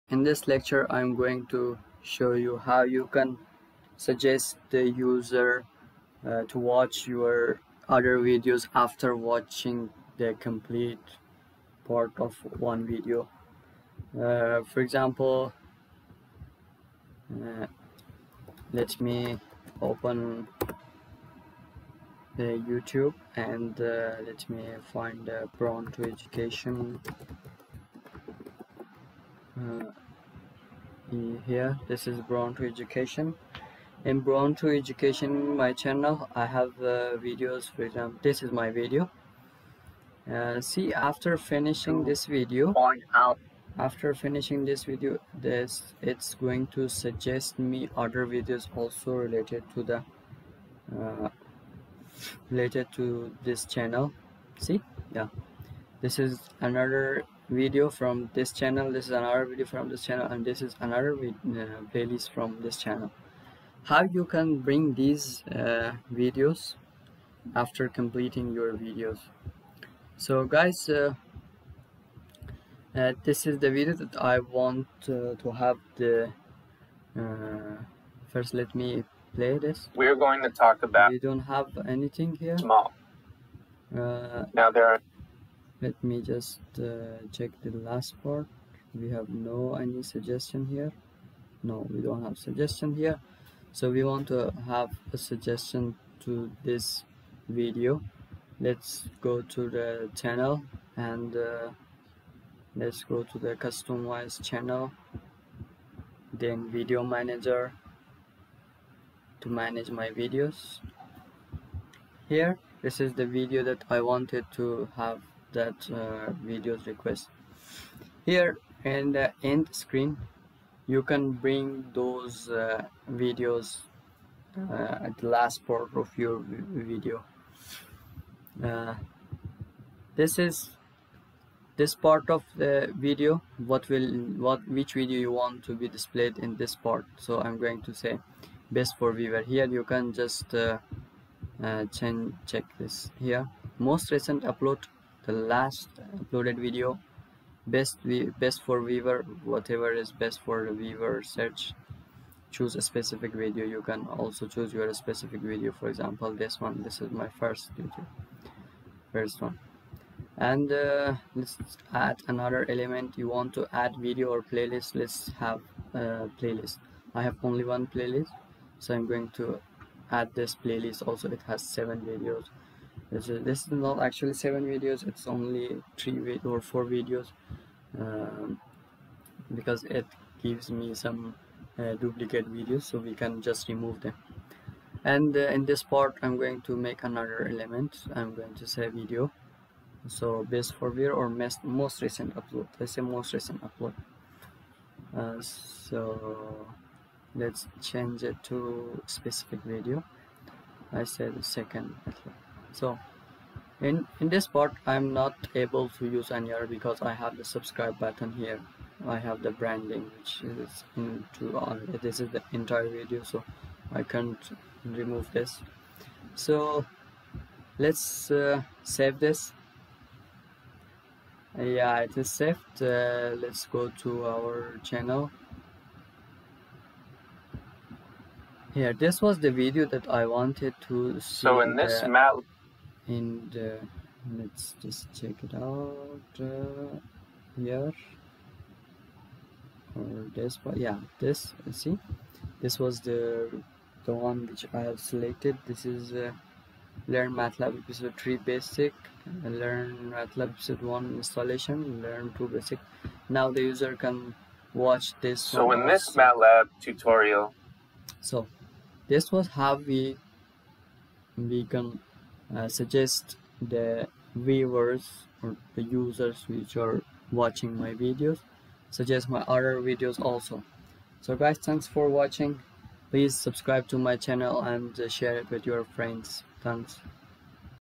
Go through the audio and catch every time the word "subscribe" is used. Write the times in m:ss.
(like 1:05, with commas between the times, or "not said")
3:27, 4:33.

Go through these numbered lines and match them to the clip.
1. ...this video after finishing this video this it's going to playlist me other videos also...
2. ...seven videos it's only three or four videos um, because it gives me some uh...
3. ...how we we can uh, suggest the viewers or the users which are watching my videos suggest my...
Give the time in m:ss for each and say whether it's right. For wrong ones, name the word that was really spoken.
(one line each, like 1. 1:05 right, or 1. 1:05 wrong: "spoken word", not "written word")
1. 0:42 wrong: "suggest", not "playlist"
2. 2:54 right
3. 4:19 right.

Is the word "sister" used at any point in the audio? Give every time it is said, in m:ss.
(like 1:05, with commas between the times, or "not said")
not said.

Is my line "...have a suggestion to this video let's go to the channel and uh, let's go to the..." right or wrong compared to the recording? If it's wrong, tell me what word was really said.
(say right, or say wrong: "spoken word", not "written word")
right.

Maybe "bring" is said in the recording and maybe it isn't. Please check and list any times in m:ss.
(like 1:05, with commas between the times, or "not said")
1:04, 2:01.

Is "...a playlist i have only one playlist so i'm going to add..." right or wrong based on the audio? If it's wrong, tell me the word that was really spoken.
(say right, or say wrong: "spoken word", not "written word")
right.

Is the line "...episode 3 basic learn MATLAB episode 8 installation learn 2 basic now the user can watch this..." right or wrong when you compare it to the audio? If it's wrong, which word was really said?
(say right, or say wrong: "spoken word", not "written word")
wrong: "1", not "8".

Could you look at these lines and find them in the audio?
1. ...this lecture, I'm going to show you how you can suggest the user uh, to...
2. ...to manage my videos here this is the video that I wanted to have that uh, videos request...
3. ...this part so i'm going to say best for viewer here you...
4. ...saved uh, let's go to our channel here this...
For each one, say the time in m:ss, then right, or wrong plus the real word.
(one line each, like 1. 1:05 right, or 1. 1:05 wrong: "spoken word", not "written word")
1. 0:00 right
2. 1:49 right
3. 2:16 right
4. 3:42 right.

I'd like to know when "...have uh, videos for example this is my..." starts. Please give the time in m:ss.
0:36.